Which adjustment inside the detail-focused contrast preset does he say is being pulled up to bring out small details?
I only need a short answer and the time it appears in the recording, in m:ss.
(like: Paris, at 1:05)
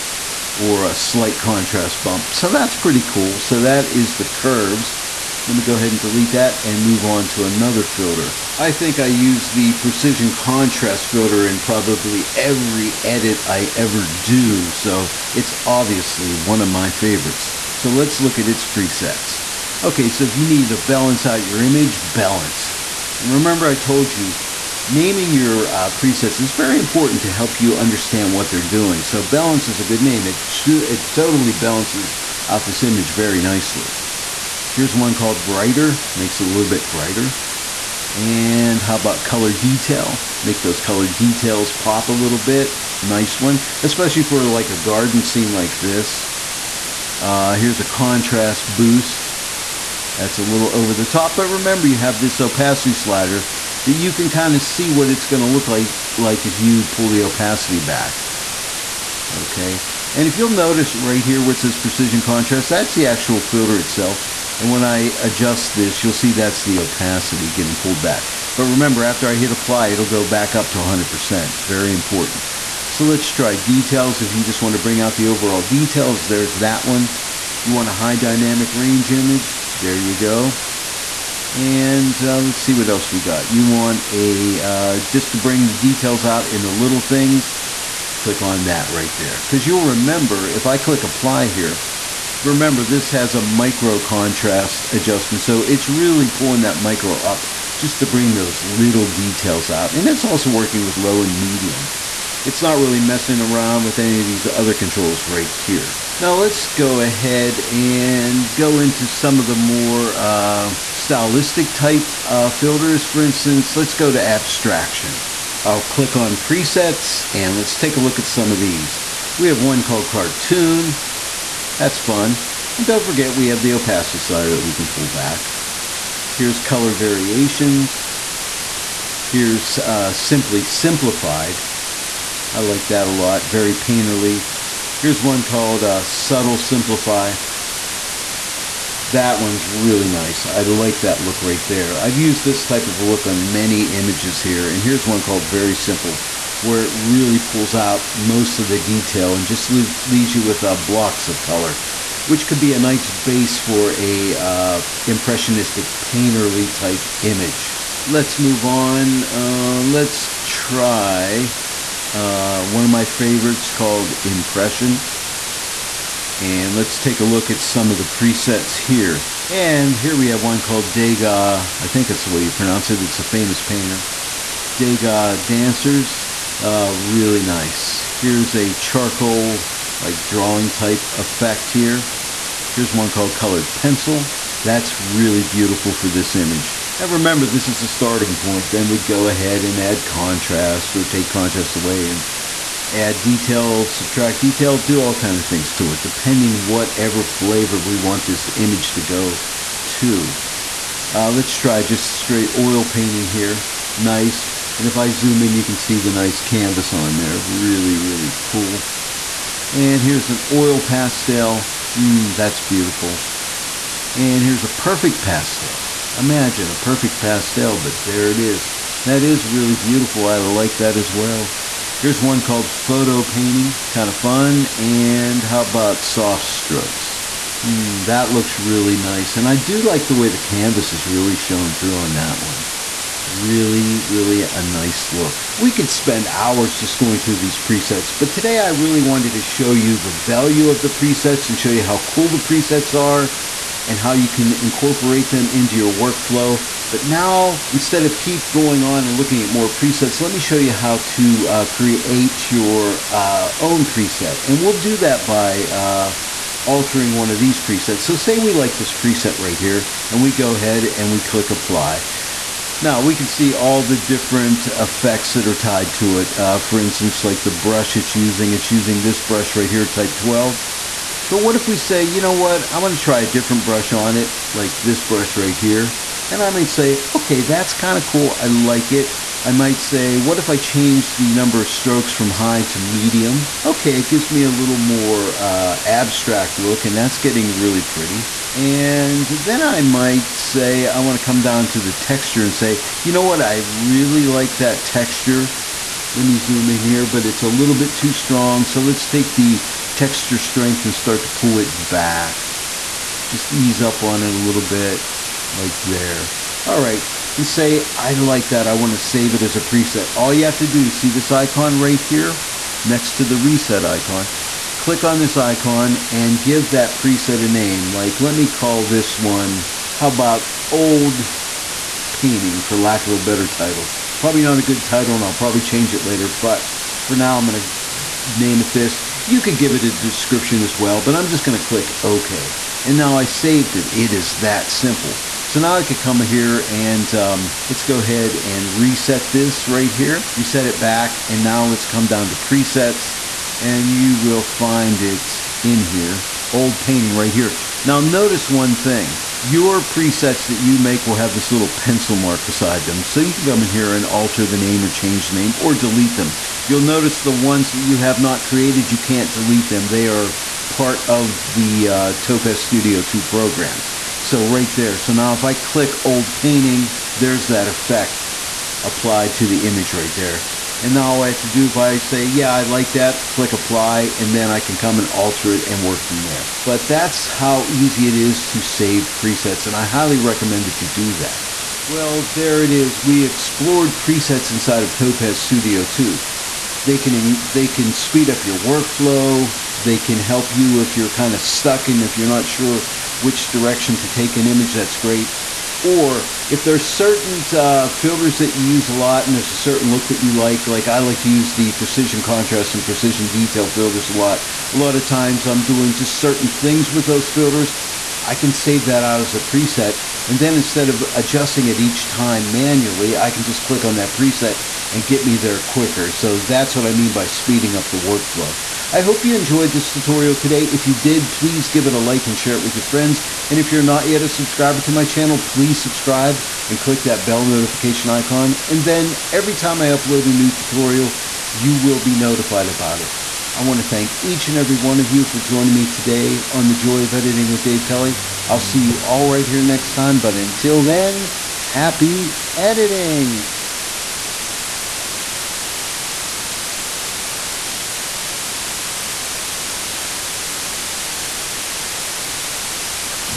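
micro contrast, at 1:33.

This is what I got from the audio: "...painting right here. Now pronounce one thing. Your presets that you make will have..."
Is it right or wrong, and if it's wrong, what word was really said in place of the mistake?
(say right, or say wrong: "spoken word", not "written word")
wrong: "notice", not "pronounce".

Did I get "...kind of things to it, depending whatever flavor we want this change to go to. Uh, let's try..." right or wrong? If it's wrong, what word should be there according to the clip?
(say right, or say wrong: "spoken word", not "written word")
wrong: "image", not "change".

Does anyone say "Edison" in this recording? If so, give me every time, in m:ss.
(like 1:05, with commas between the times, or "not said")
not said.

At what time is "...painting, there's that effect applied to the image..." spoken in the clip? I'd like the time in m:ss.
6:06.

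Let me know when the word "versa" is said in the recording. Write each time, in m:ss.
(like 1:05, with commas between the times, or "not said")
not said.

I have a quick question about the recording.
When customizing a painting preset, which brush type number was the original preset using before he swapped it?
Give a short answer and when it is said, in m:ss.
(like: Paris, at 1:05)
12, at 4:29.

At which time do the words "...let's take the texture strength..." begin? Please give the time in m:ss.
4:58.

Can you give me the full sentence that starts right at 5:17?
Like, let me call this one, how about old painting, for lack of a better title.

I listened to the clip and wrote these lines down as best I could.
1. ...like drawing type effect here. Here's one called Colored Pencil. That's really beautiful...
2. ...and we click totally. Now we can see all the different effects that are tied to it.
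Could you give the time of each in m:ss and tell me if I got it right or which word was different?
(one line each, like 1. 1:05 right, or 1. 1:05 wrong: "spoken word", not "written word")
1. 2:59 right
2. 4:20 wrong: "apply", not "totally".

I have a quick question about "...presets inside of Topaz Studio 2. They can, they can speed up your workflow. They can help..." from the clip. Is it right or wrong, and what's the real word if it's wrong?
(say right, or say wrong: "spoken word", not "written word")
right.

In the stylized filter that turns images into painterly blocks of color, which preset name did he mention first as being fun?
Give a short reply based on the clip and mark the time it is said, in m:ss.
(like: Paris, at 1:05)
Cartoon, at 2:00.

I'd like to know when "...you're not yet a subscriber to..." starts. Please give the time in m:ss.
7:03.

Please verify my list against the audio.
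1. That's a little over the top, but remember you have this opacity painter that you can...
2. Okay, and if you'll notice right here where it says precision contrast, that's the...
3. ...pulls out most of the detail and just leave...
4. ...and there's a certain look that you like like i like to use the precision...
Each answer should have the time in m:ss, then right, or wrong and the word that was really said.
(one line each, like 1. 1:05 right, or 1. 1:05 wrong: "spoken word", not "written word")
1. 0:50 wrong: "slider", not "painter"
2. 0:59 right
3. 2:27 right
4. 6:39 right.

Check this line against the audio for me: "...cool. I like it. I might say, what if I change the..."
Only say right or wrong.
right.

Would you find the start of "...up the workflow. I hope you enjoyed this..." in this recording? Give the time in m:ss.
6:57.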